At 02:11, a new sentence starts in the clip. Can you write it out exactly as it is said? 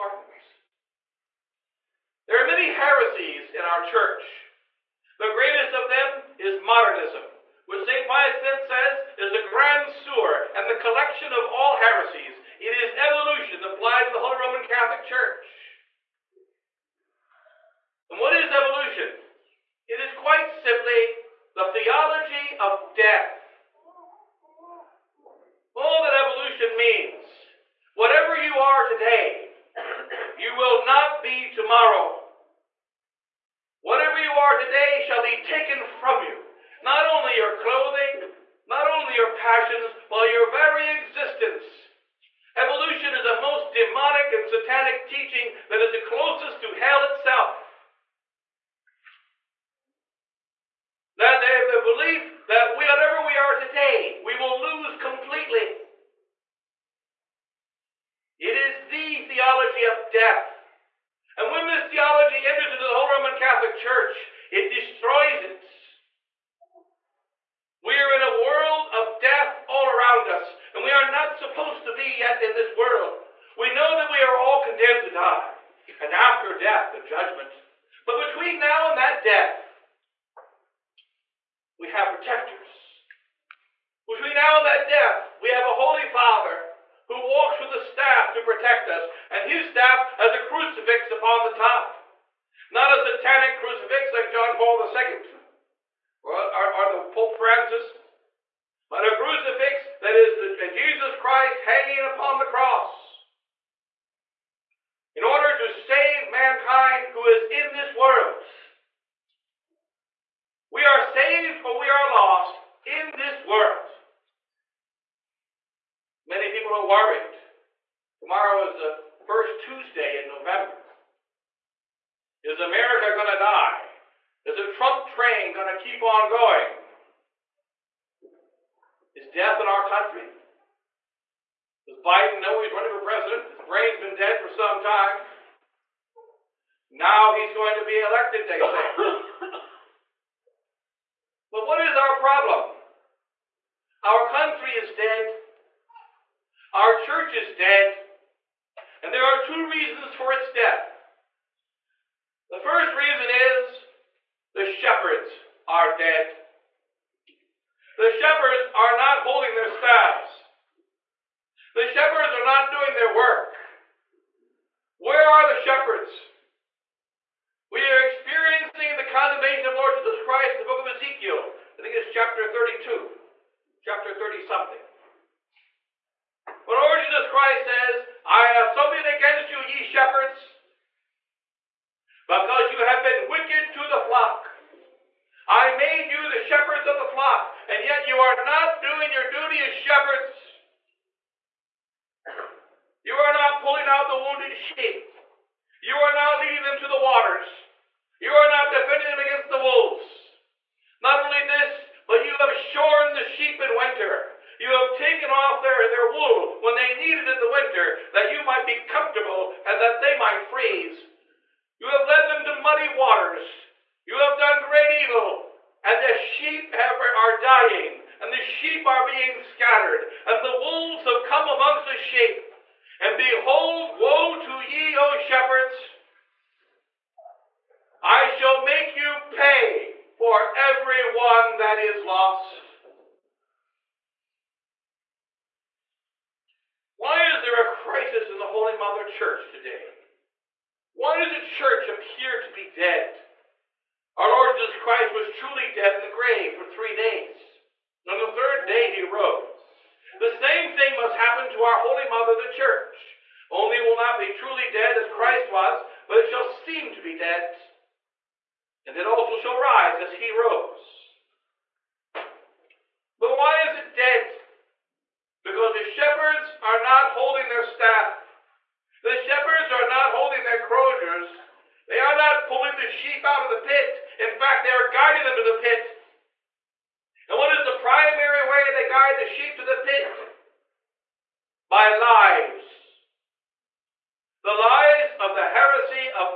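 Does Biden know he's running for president?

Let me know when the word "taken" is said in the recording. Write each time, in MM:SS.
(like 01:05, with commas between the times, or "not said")
00:35, 03:24.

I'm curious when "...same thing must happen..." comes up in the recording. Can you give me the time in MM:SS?
04:10.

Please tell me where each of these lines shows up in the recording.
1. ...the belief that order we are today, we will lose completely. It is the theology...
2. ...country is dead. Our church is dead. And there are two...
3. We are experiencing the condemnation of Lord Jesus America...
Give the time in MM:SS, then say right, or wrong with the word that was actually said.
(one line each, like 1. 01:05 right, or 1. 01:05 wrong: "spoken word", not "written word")
1. 00:51 wrong: "whatever", not "order"
2. 02:24 right
3. 02:47 wrong: "Christ", not "America".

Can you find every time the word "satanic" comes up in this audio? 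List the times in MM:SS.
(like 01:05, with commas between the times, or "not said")
00:44, 01:33.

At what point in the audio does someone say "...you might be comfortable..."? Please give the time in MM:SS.
03:28.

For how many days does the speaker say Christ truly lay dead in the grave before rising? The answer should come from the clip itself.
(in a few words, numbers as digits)
3.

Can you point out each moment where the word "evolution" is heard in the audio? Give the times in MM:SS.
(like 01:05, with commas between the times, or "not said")
00:12, 00:18, 00:26, 00:42.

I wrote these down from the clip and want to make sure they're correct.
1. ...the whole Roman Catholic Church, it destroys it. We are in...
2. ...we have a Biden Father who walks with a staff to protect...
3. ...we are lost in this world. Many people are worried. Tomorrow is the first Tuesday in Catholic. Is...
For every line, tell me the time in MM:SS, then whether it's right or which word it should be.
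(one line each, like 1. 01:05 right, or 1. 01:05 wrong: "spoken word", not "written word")
1. 01:02 right
2. 01:25 wrong: "Holy", not "Biden"
3. 01:51 wrong: "November", not "Catholic".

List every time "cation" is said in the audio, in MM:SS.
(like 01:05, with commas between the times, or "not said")
not said.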